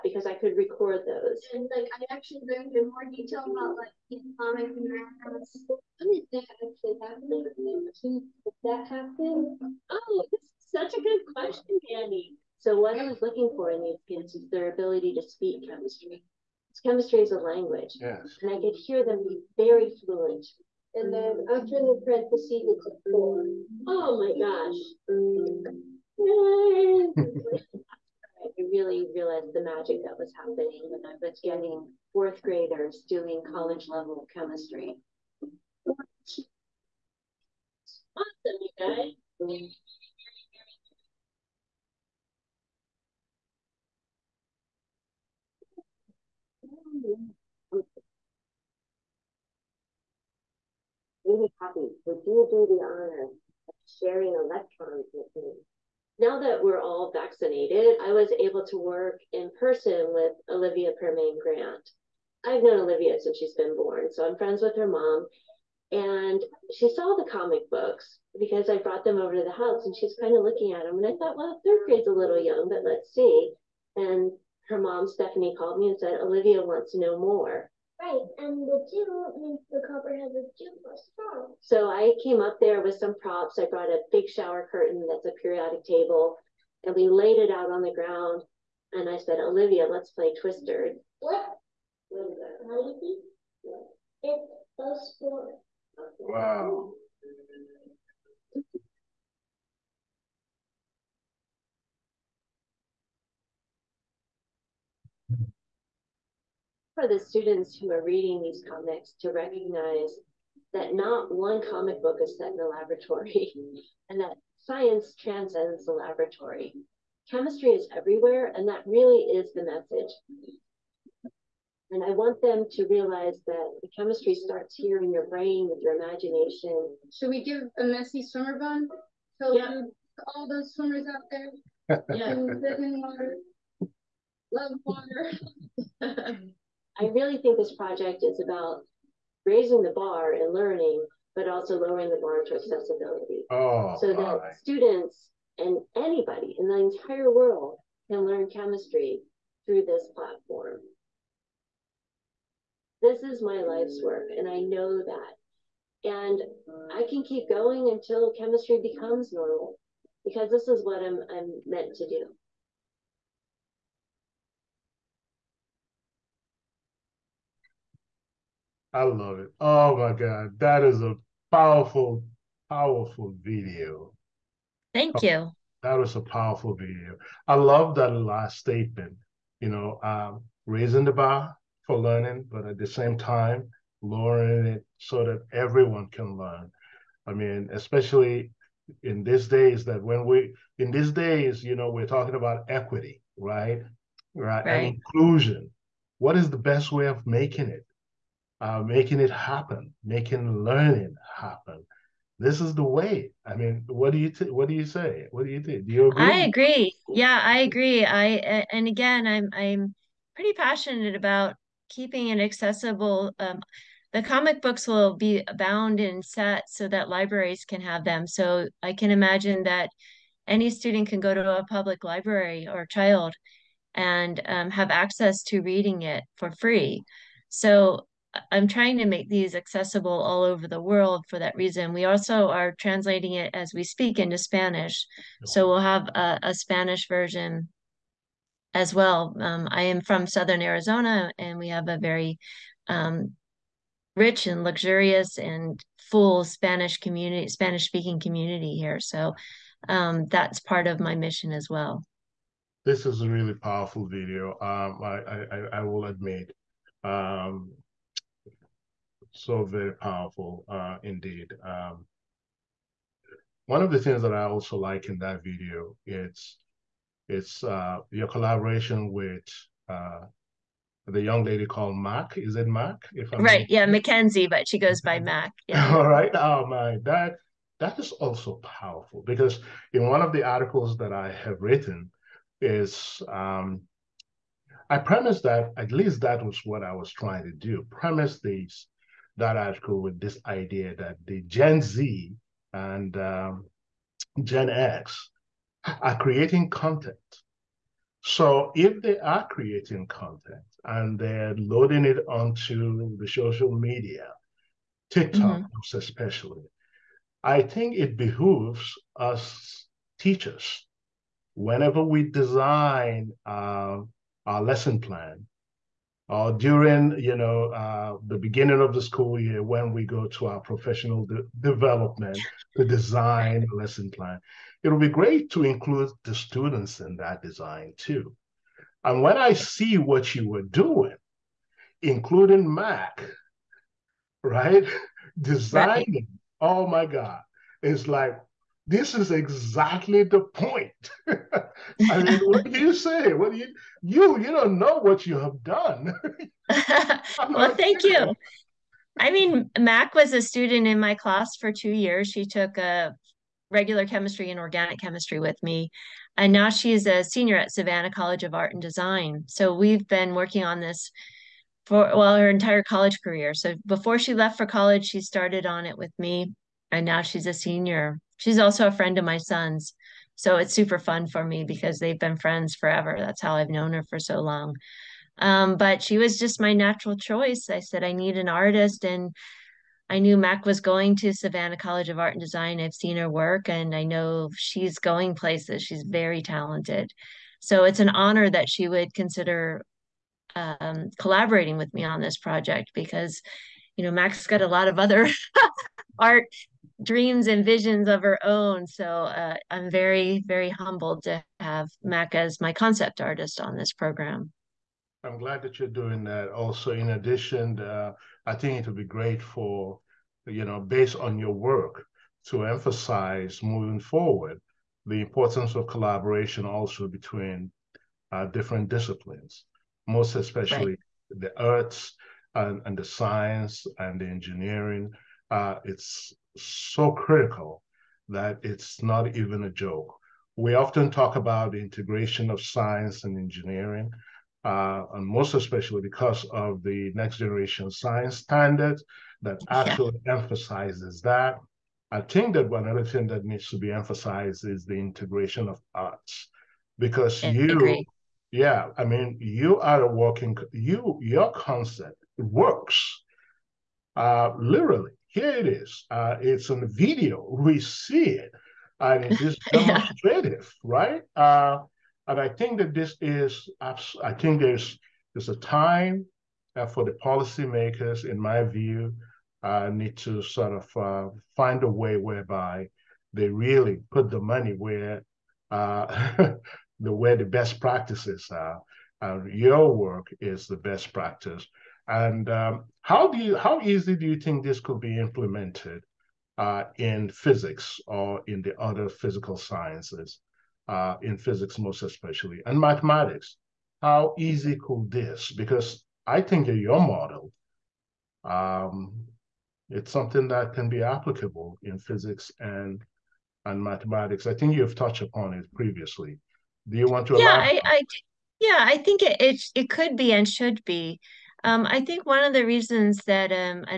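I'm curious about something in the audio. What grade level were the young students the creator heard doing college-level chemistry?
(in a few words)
fourth graders.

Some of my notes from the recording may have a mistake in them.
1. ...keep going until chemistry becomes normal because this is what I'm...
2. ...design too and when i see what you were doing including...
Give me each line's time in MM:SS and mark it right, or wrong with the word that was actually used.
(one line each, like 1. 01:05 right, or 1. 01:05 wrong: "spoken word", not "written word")
1. 02:37 right
2. 05:27 right.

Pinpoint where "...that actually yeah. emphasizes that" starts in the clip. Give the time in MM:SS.
07:19.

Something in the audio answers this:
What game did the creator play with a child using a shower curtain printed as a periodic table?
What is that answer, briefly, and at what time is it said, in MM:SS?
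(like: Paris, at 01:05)
Twister, at 01:30.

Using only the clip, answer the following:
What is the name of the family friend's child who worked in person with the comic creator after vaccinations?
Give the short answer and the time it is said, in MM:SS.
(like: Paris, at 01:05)
Olivia Permain Grant, at 01:00.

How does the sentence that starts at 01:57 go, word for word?
Chemistry is everywhere, and that really is the message.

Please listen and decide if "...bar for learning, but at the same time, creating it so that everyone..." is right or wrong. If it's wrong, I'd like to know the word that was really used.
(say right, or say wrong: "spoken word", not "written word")
wrong: "lowering", not "creating".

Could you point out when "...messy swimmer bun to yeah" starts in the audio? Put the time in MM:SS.
02:07.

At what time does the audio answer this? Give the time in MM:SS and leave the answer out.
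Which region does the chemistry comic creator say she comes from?
04:00.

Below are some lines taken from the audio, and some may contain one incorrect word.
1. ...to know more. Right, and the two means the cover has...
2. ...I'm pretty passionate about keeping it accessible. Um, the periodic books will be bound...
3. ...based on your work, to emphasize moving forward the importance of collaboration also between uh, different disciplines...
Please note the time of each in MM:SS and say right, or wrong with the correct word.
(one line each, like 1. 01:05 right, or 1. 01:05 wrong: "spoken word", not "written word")
1. 01:16 right
2. 03:29 wrong: "comic", not "periodic"
3. 06:50 right.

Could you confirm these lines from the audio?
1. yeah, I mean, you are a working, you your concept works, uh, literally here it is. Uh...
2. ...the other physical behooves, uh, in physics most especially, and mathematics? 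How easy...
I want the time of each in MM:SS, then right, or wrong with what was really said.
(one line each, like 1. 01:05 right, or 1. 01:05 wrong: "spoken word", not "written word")
1. 07:28 right
2. 08:08 wrong: "sciences", not "behooves".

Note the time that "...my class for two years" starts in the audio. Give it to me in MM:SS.
05:50.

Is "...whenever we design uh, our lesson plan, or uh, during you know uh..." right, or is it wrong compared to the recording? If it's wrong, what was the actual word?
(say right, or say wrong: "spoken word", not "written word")
right.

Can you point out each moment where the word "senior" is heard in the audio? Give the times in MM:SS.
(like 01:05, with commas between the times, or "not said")
05:57, 06:07.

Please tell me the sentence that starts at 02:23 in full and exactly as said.
Oh, so that students and anybody in the entire world can learn chemistry through this platform.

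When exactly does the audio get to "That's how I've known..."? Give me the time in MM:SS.
06:13.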